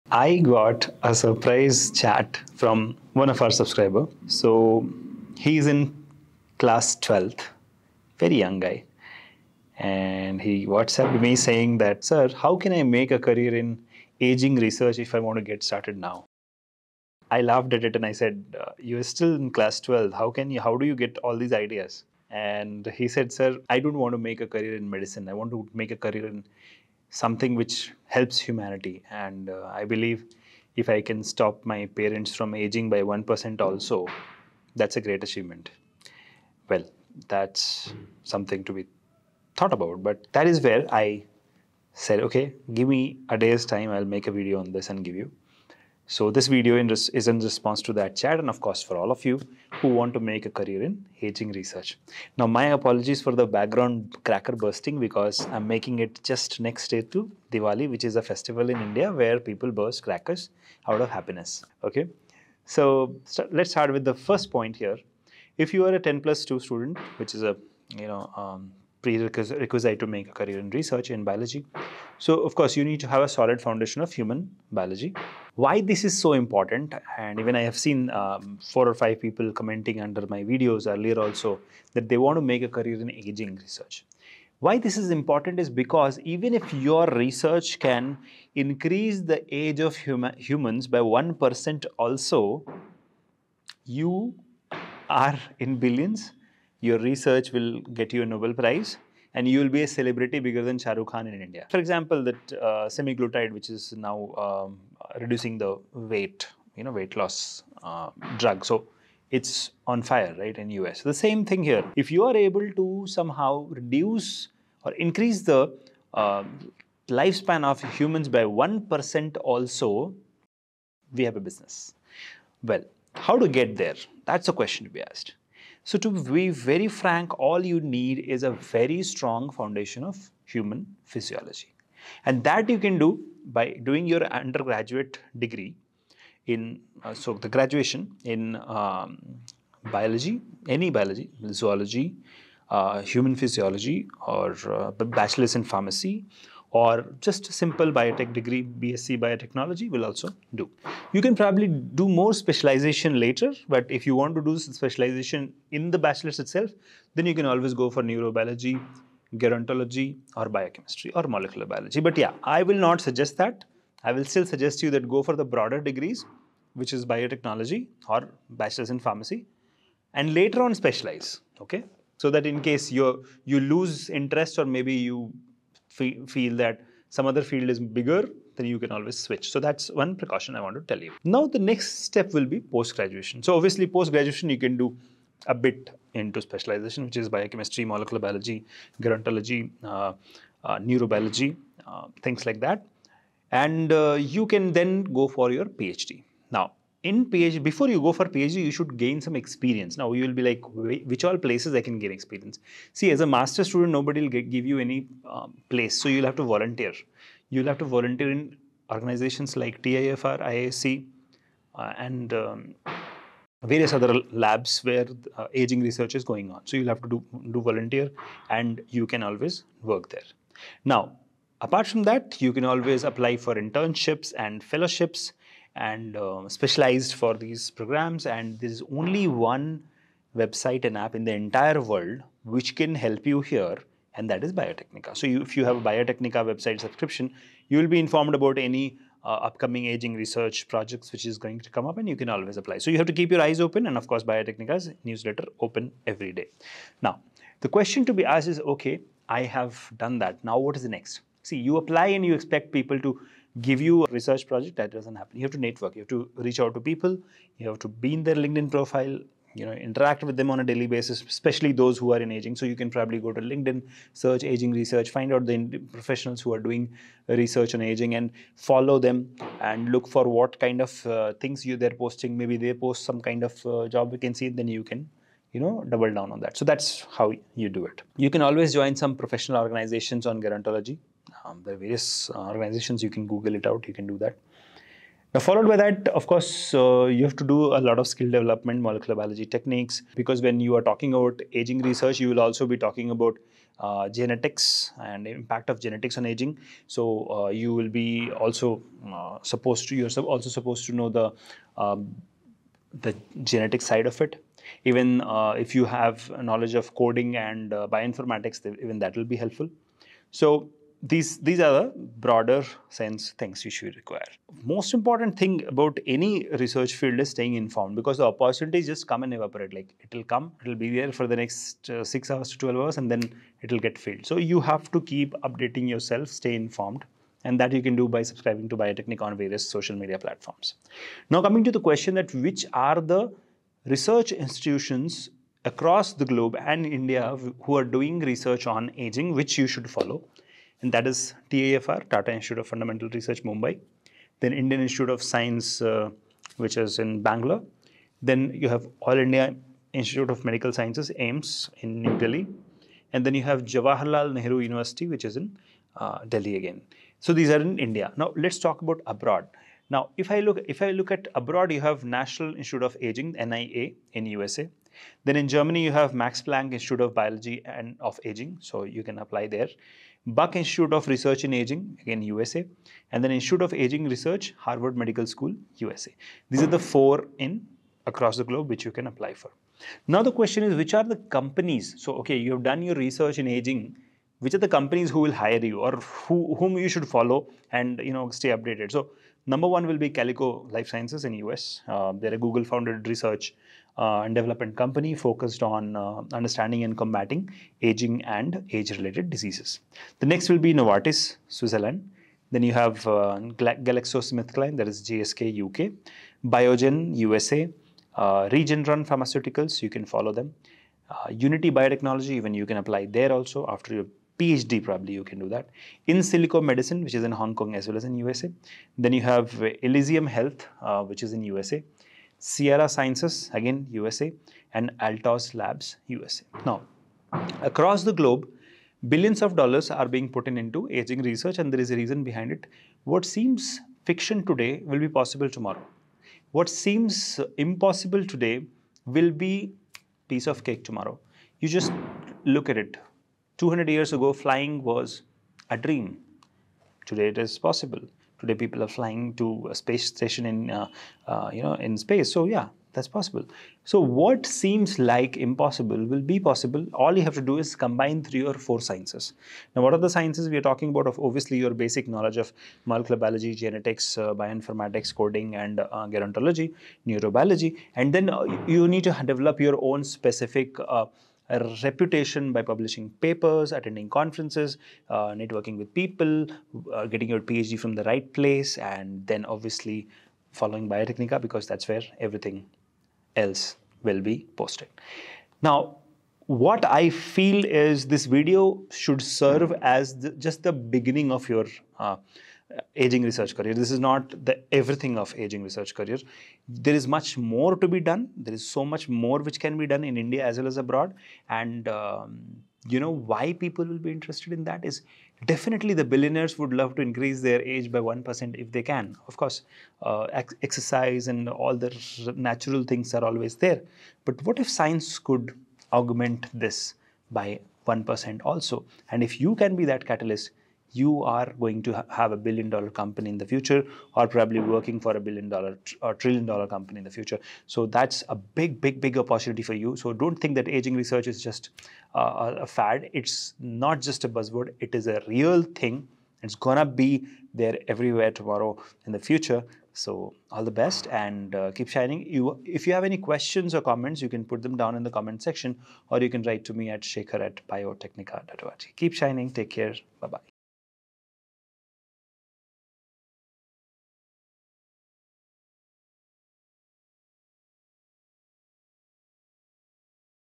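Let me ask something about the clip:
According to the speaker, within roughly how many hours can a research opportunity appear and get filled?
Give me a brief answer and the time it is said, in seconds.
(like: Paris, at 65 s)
6 to 12 hours, at 322 s.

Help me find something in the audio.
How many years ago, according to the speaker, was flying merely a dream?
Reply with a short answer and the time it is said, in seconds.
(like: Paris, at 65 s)
200, at 443 s.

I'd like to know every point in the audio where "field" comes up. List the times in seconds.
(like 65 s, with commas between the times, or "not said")
177 s, 316 s.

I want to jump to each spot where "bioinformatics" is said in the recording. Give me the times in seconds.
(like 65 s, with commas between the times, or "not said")
307 s, 464 s.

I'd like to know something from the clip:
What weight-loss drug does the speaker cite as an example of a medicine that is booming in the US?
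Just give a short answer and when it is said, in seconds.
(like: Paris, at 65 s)
semaglutide, at 102 s.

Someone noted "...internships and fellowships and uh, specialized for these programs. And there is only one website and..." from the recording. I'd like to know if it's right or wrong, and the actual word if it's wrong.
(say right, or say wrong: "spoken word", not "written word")
right.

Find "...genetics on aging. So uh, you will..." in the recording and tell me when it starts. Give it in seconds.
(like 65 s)
295 s.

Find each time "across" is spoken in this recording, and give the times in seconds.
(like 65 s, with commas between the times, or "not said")
335 s, 378 s, 427 s.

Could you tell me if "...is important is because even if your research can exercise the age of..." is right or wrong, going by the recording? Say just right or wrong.
wrong.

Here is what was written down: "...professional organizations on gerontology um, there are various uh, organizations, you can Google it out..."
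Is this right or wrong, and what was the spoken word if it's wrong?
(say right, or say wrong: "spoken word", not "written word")
right.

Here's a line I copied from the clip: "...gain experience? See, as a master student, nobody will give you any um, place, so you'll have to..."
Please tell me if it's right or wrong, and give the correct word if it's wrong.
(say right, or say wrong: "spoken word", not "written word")
right.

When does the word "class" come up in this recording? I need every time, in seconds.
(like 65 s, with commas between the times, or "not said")
6 s, 19 s.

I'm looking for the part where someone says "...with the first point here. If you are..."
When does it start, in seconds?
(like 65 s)
63 s.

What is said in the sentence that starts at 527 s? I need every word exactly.
So that's a big, big, big opportunity for you.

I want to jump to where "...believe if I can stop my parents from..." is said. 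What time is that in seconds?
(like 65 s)
29 s.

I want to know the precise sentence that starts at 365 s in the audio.
Then in Germany, you have Max Planck Institute of Biology and of Aging, so you can apply there.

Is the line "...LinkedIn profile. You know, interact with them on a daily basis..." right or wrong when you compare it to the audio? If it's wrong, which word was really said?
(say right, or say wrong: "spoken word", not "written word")
right.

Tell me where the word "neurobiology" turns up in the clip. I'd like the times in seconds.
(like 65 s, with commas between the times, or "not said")
158 s, 190 s, 467 s.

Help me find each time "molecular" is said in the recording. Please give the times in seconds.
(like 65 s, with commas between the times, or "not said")
161 s, 187 s, 288 s, 462 s.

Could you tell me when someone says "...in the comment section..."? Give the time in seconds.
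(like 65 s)
544 s.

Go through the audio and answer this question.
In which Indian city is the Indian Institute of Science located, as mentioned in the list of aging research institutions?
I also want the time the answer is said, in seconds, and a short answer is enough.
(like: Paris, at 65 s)
Bangalore, at 347 s.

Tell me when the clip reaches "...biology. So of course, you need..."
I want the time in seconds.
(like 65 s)
71 s.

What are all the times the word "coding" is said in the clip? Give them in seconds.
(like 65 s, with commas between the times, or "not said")
306 s, 465 s.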